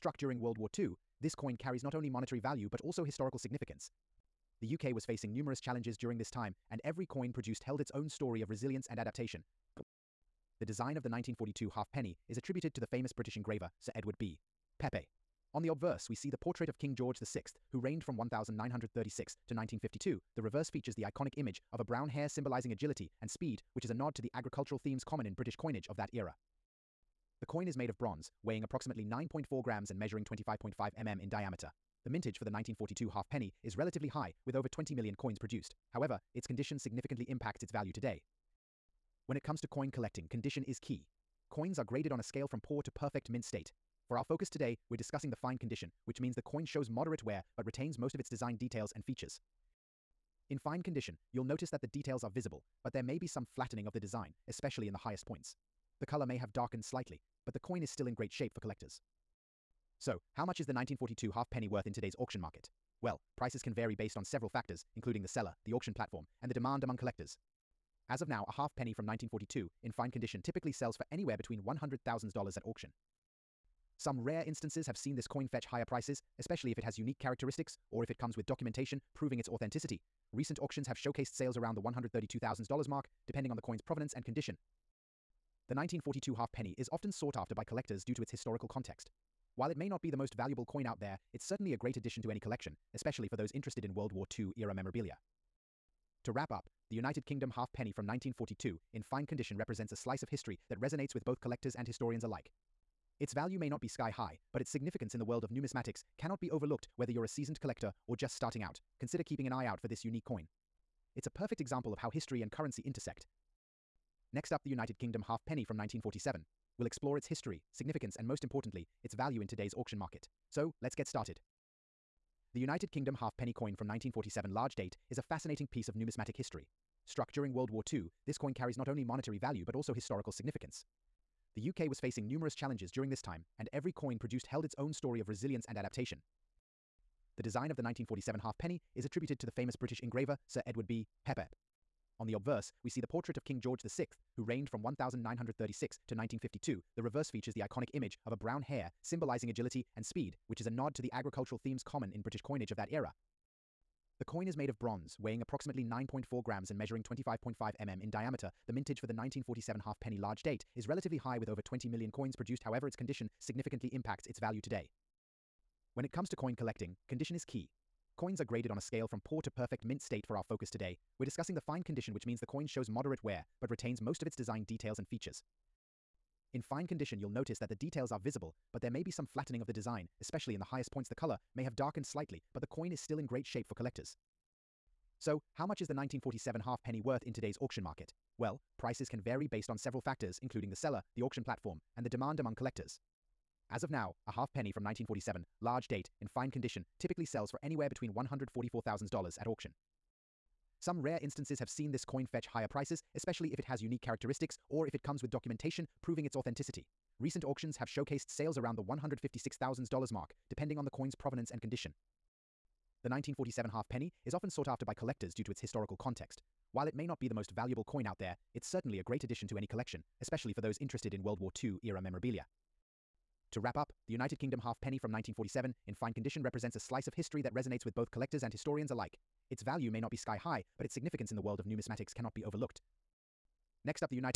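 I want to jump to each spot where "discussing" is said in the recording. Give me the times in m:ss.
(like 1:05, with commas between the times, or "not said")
0:44, 2:51.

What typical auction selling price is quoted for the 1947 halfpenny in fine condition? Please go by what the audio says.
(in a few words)
$144,000.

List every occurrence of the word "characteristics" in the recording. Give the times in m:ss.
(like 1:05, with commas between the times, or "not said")
1:17, 3:24.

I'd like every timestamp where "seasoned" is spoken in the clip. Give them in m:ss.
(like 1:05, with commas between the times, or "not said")
1:47.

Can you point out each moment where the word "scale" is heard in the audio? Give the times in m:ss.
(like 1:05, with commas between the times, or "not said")
0:42, 2:48.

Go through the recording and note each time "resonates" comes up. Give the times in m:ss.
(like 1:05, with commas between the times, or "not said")
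1:40, 3:47.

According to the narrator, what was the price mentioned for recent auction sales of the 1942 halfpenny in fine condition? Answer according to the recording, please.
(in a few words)
$132,000.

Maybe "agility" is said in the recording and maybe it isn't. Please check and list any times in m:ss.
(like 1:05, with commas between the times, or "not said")
0:22, 2:29.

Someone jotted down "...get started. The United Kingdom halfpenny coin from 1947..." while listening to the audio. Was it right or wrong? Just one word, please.
right.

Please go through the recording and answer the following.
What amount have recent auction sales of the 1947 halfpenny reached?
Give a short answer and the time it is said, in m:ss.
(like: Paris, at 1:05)
$156,000, at 3:28.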